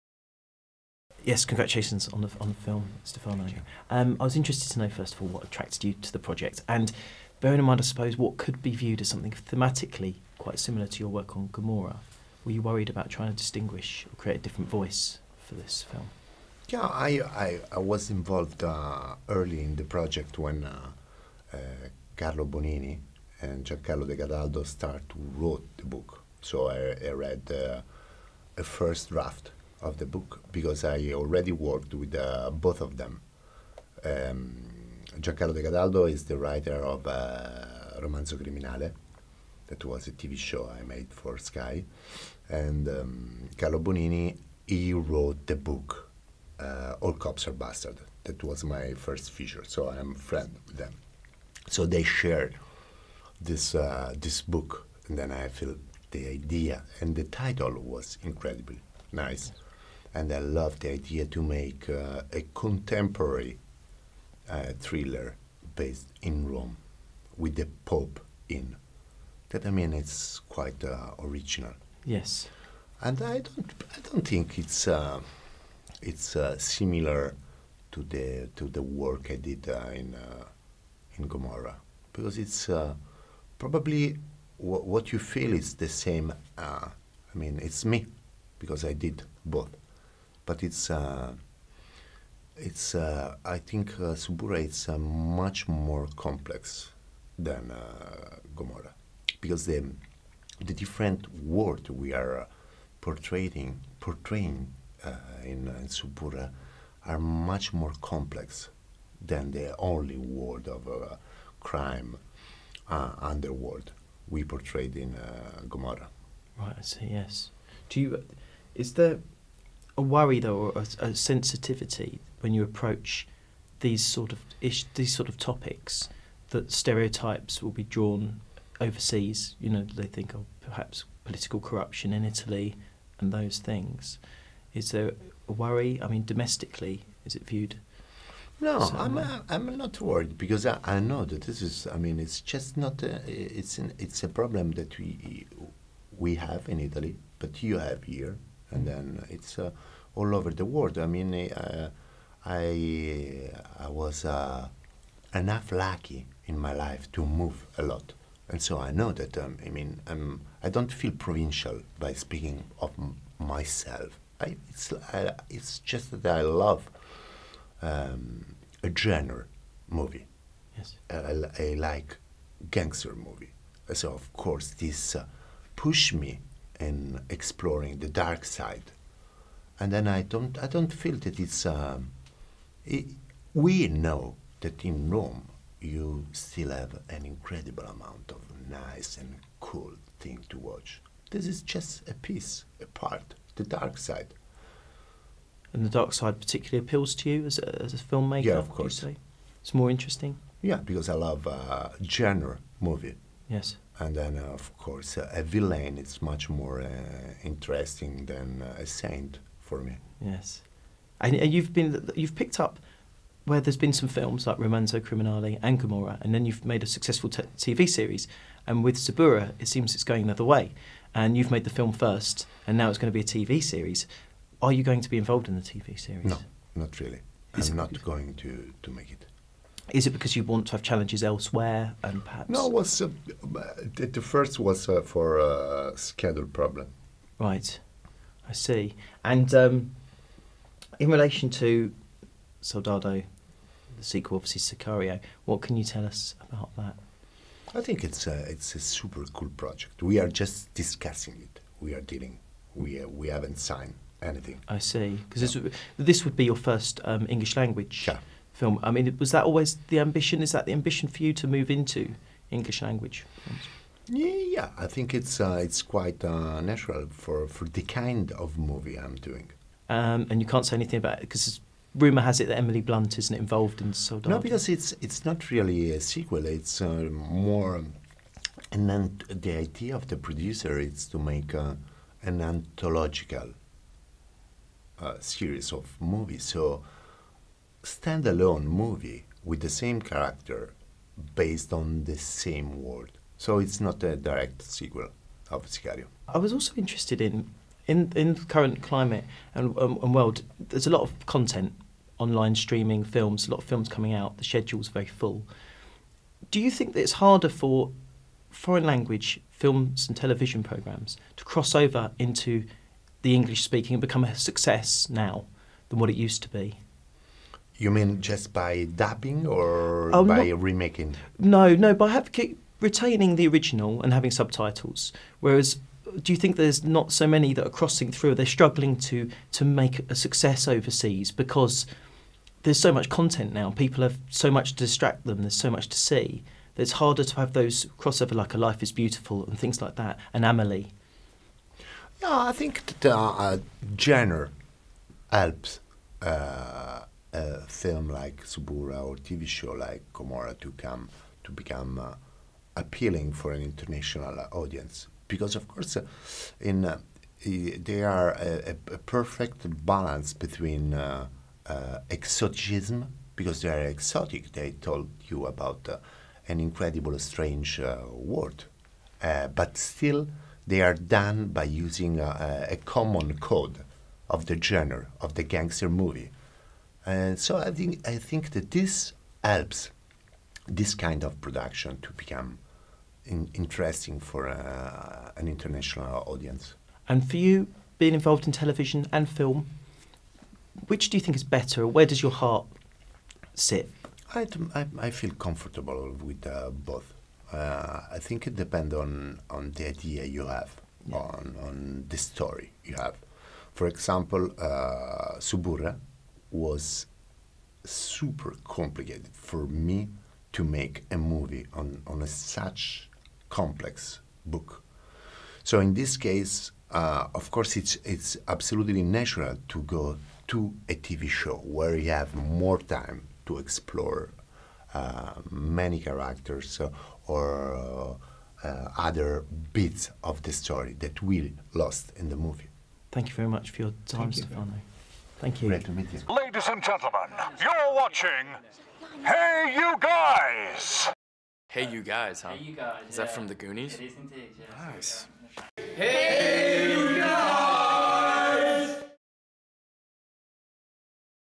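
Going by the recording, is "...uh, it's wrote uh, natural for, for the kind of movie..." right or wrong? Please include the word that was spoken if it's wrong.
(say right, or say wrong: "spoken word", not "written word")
wrong: "quite", not "wrote".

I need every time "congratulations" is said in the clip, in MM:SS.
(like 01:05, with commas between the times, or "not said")
00:01.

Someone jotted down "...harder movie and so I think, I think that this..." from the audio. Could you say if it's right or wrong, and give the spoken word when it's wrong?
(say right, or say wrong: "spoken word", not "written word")
wrong: "gangster", not "harder".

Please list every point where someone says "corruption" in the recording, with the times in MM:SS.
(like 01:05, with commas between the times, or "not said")
02:11.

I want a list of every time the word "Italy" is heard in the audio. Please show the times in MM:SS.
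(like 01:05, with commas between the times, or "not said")
02:12, 02:26.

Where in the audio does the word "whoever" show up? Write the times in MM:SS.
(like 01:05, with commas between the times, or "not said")
not said.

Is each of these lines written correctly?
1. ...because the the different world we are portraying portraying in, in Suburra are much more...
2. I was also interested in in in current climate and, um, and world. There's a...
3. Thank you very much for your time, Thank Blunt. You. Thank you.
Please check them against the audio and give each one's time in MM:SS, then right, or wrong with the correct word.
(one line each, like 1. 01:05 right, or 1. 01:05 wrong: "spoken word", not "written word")
1. 01:39 right
2. 04:56 right
3. 07:13 wrong: "Stefano", not "Blunt".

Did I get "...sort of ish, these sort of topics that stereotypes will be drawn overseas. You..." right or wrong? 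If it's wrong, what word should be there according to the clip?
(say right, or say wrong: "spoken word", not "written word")
right.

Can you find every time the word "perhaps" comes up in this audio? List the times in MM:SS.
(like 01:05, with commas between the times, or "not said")
02:10, 03:52.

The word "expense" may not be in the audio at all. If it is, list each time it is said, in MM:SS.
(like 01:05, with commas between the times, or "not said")
not said.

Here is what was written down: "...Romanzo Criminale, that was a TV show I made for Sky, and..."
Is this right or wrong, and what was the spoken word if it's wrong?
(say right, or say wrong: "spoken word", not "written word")
right.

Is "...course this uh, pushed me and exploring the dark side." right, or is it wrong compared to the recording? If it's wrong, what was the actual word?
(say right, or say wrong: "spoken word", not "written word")
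right.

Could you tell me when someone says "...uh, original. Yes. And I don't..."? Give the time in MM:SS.
01:10.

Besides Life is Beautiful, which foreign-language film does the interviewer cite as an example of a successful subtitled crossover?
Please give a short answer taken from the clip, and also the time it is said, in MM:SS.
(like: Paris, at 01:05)
Amelie, at 05:40.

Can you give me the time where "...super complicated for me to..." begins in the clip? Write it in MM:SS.
06:47.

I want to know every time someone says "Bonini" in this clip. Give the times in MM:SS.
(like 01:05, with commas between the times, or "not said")
00:22, 00:43.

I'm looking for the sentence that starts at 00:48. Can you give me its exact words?
That was my first feature, so I'm friend with them.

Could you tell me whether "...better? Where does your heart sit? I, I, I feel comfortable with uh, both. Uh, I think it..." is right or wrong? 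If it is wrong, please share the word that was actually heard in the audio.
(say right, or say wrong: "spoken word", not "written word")
right.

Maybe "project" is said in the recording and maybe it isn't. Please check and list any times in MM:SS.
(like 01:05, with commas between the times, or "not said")
00:06, 00:19, 04:09.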